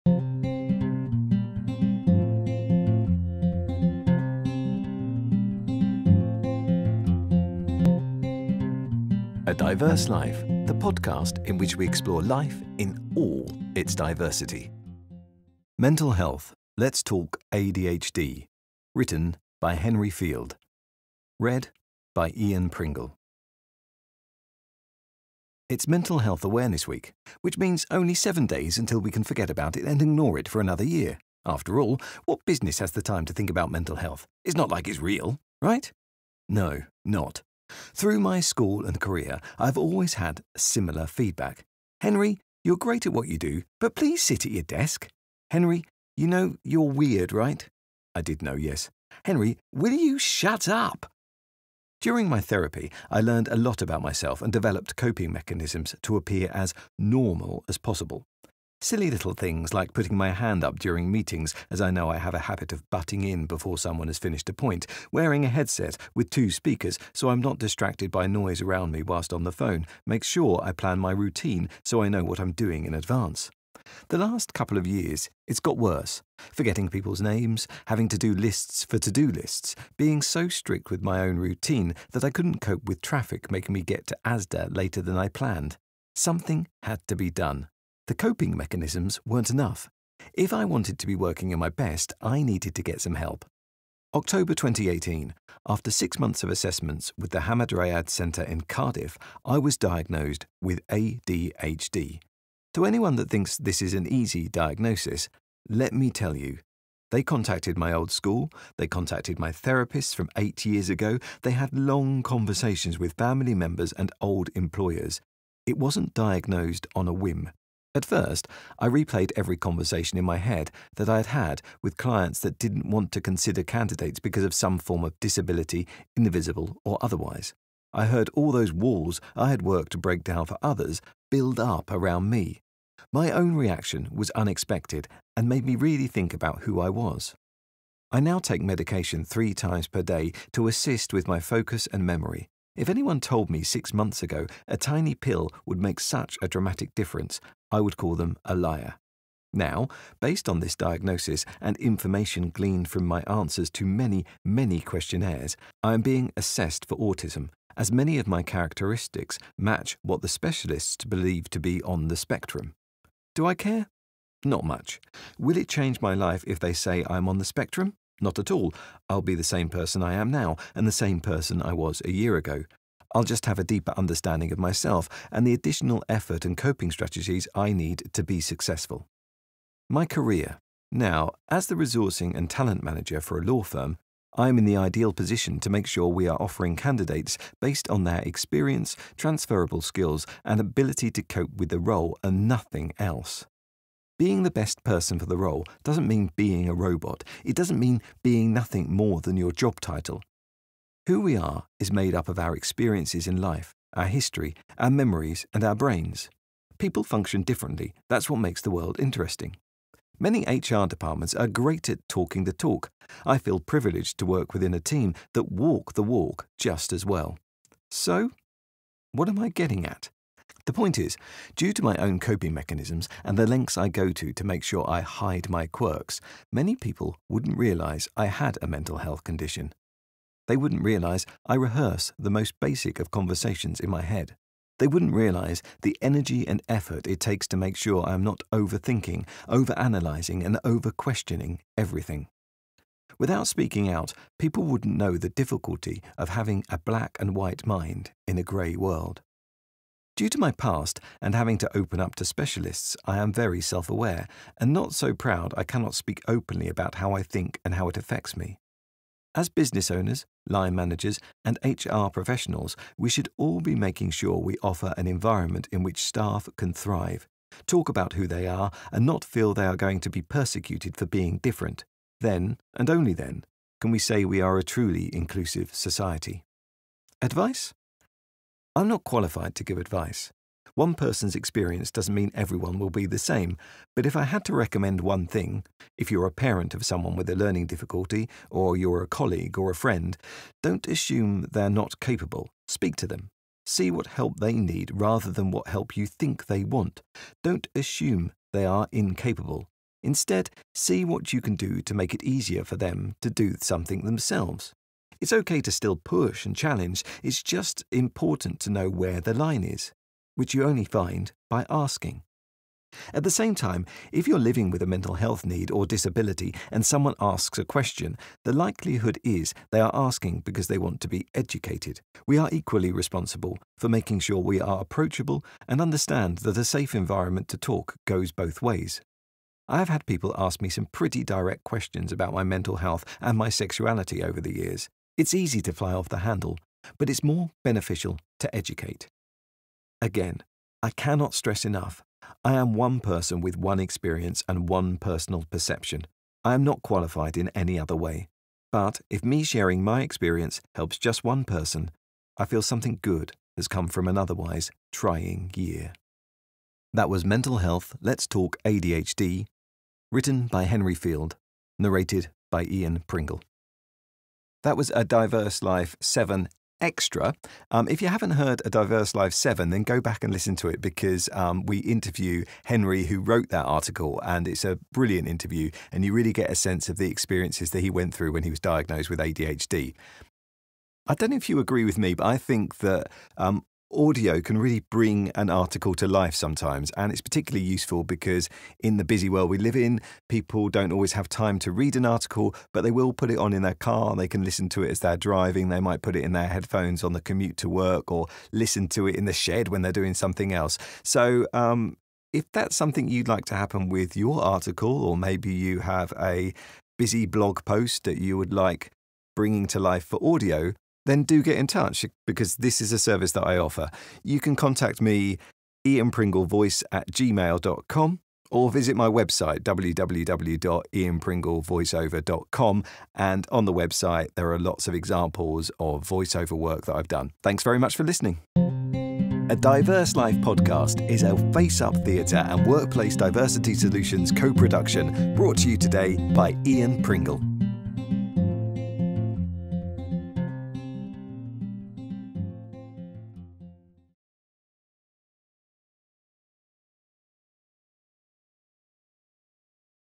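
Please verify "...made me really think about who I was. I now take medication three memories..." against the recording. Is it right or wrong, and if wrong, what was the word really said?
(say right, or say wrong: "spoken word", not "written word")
wrong: "times", not "memories".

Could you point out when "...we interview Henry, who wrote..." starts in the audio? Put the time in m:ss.
6:11.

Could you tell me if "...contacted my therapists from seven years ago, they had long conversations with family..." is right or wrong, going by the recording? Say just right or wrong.
wrong.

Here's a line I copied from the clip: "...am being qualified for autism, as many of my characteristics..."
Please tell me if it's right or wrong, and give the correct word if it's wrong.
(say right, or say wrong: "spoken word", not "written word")
wrong: "assessed", not "qualified".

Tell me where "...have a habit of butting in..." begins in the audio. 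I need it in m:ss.
1:02.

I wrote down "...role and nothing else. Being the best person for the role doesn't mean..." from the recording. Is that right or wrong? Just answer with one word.
right.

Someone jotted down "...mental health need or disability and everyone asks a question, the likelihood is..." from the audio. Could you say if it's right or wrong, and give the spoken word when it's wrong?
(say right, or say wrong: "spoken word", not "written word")
wrong: "someone", not "everyone".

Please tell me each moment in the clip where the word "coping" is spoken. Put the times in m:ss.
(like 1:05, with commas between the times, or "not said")
0:54, 1:28, 2:56, 3:42.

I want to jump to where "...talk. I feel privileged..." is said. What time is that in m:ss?
3:32.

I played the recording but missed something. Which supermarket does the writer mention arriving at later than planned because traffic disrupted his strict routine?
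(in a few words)
Asda.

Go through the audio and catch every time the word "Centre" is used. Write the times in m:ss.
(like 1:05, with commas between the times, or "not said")
1:38.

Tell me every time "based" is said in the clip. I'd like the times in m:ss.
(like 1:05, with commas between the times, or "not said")
2:30, 3:07.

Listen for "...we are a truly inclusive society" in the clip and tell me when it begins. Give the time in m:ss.
4:34.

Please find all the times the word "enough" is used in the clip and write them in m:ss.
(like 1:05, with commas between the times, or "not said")
1:29, 5:41.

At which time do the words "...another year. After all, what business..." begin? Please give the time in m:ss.
0:30.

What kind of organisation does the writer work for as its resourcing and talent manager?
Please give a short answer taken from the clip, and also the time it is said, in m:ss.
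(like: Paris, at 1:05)
Law firm, at 3:03.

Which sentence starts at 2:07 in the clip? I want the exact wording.
I heard all those walls I had worked to break down for others build up around me.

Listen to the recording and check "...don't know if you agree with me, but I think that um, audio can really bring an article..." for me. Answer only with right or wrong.
right.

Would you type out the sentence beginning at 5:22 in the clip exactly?
We are equally responsible for making sure we are approachable and understand that a safe environment to talk goes both ways.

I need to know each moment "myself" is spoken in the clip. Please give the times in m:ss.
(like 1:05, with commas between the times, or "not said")
0:54, 2:54.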